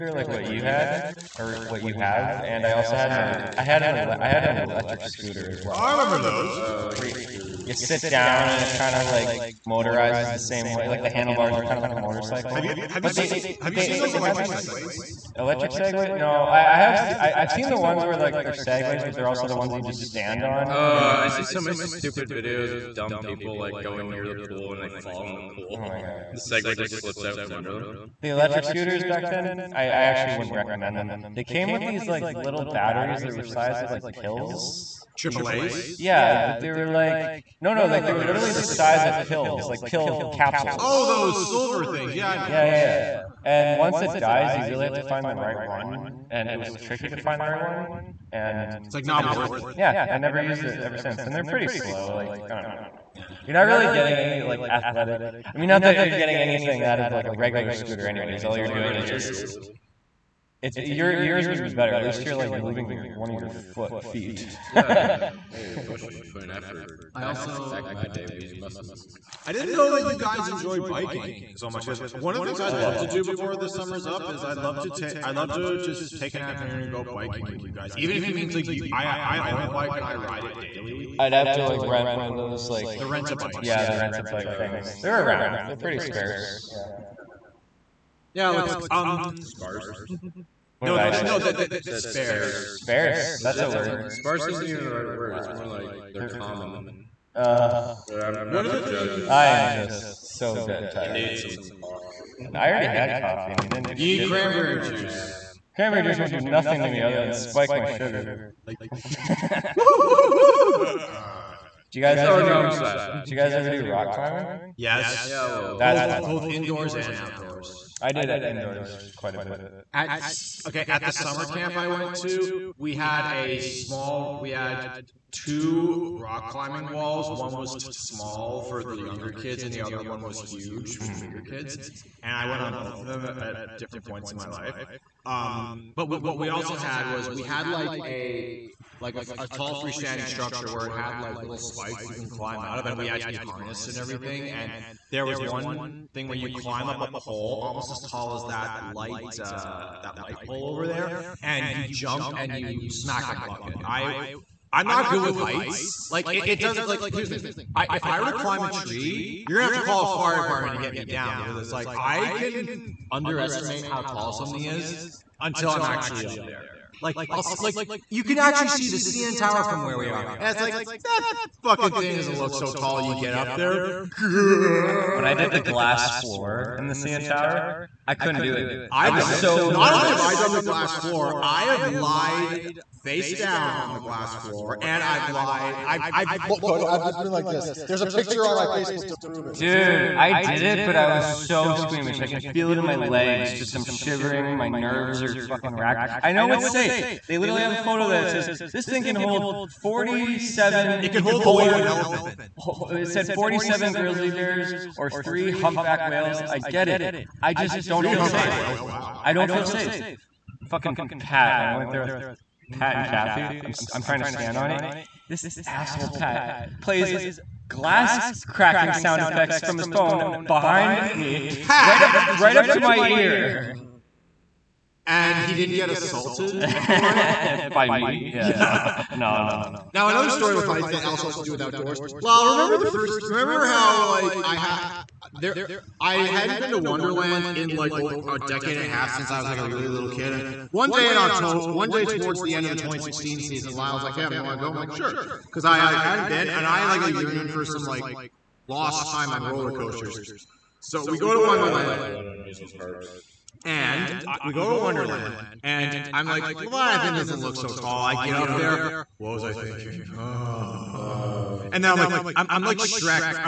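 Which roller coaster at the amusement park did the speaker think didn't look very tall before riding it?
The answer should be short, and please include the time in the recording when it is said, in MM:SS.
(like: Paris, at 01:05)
Leviathan, at 04:16.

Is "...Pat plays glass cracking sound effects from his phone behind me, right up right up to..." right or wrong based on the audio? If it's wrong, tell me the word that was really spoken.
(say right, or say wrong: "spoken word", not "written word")
right.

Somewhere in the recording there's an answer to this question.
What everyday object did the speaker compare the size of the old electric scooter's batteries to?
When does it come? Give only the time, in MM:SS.
00:39.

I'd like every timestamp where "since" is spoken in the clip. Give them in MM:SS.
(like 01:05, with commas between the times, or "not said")
00:50, 03:59.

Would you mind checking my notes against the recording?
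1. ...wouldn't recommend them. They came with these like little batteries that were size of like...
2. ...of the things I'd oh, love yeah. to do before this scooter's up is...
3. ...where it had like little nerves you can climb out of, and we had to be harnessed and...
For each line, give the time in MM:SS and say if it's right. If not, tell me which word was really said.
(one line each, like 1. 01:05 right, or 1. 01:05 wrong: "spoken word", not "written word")
1. 00:30 right
2. 01:12 wrong: "summer", not "scooter"
3. 02:20 wrong: "spikes", not "nerves".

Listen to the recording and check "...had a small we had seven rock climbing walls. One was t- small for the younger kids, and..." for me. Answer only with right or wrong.
wrong.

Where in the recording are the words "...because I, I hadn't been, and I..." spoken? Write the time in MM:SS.
04:05.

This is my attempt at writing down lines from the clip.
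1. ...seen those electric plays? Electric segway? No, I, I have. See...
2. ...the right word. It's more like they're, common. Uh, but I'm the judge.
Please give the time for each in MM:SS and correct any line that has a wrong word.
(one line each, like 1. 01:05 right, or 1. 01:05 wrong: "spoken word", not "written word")
1. 00:13 wrong: "segways", not "plays"
2. 01:34 right.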